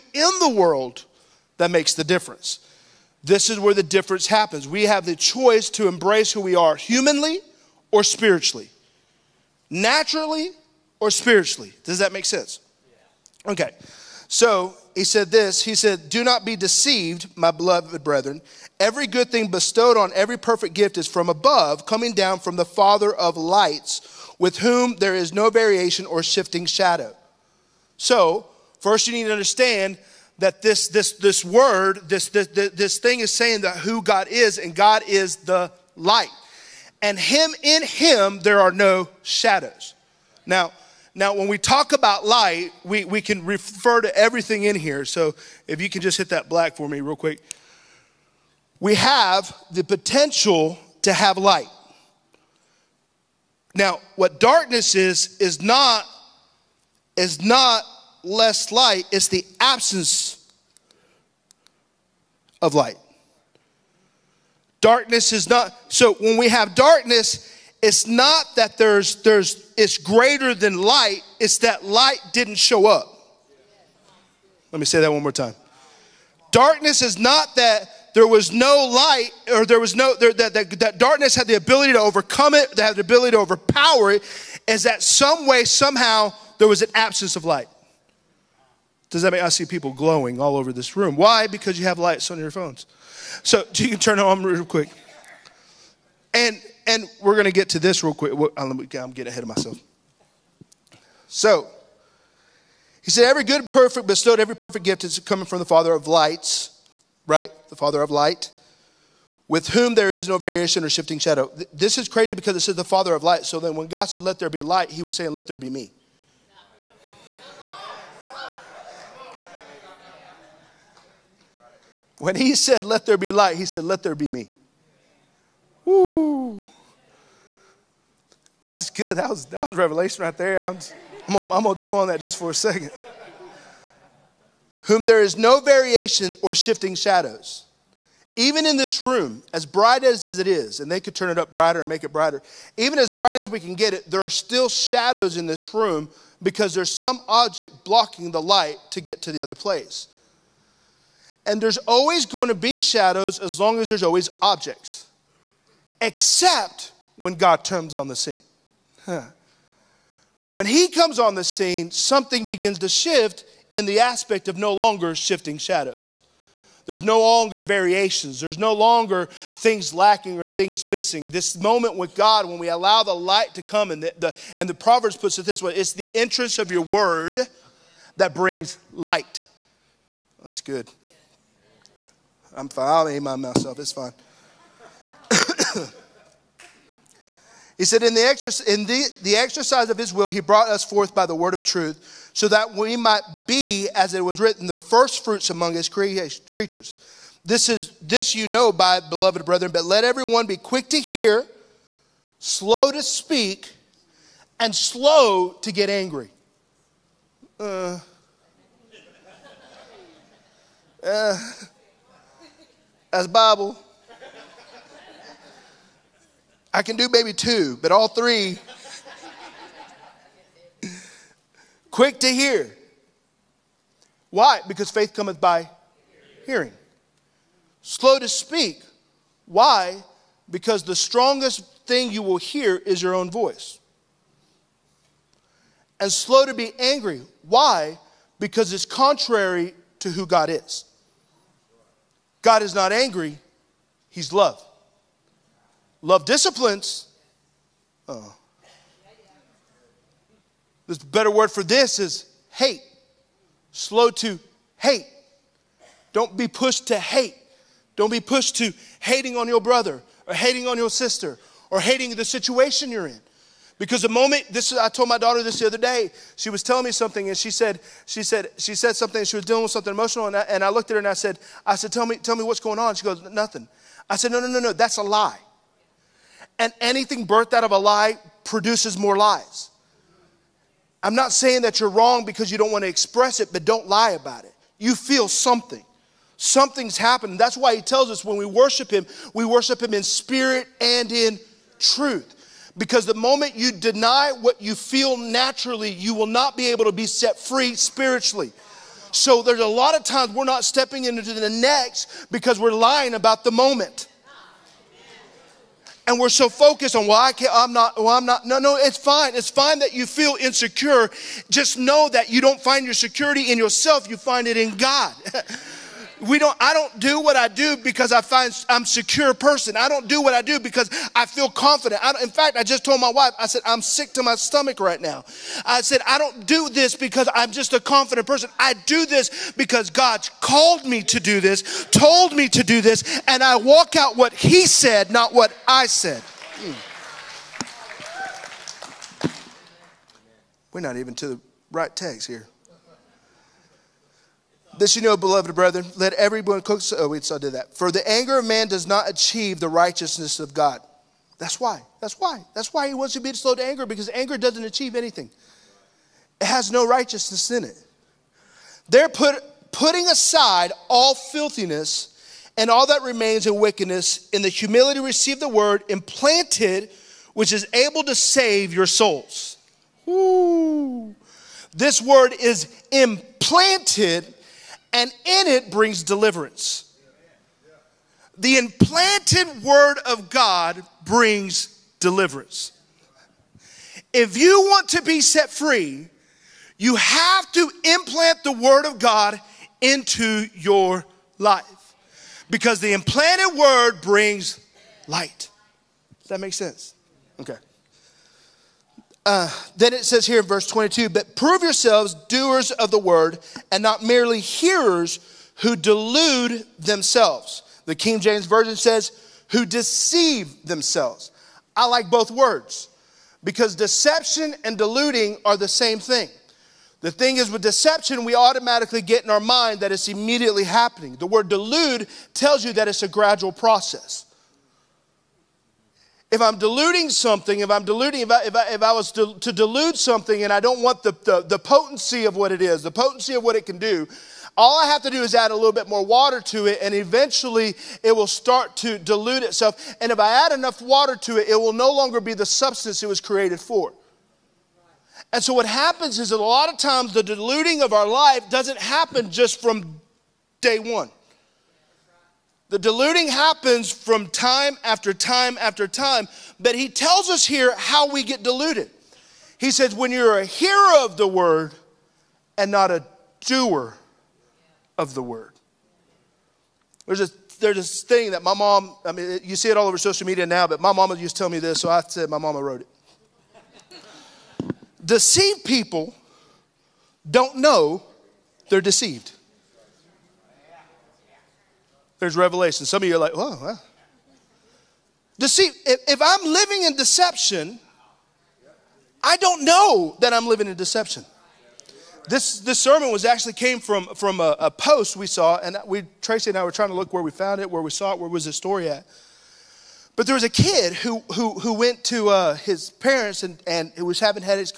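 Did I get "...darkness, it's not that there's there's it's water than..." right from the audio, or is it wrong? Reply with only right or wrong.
wrong.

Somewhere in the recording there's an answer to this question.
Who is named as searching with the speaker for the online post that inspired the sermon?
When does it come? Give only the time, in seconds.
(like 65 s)
496 s.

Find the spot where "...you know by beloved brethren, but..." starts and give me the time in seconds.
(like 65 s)
198 s.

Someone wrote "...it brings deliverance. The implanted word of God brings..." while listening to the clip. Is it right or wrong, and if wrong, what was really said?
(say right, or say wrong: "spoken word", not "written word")
right.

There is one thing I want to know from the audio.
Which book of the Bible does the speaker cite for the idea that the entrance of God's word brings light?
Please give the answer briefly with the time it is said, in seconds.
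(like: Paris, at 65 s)
Proverbs, at 174 s.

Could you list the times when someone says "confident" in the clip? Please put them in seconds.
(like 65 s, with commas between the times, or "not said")
321 s, 327 s.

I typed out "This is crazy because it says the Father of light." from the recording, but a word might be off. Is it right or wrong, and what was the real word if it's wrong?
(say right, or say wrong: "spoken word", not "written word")
right.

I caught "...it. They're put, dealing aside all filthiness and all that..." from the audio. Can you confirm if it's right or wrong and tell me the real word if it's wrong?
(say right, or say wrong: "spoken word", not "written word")
wrong: "putting", not "dealing".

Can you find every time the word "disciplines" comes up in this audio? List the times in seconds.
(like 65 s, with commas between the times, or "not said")
246 s.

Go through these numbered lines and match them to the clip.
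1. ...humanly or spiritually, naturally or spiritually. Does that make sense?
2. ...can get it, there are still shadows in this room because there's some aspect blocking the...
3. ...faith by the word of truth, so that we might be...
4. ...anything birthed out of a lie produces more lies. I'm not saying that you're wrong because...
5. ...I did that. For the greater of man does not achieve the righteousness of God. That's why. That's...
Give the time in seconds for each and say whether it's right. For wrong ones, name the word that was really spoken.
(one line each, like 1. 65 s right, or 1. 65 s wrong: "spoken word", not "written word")
1. 6 s right
2. 143 s wrong: "object", not "aspect"
3. 190 s wrong: "forth", not "faith"
4. 276 s right
5. 347 s wrong: "anger", not "greater".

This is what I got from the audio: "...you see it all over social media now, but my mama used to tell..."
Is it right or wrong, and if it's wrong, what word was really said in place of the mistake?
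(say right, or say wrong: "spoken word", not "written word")
right.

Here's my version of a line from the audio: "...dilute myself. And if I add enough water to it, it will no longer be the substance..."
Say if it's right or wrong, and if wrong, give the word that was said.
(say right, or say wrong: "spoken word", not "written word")
wrong: "itself", not "myself".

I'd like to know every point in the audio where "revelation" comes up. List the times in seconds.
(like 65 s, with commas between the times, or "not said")
129 s, 482 s.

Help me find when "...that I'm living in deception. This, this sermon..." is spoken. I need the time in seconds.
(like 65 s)
490 s.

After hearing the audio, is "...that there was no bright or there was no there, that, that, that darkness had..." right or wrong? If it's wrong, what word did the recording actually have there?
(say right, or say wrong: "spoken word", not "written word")
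wrong: "light", not "bright".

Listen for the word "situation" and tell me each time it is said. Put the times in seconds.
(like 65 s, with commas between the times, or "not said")
262 s.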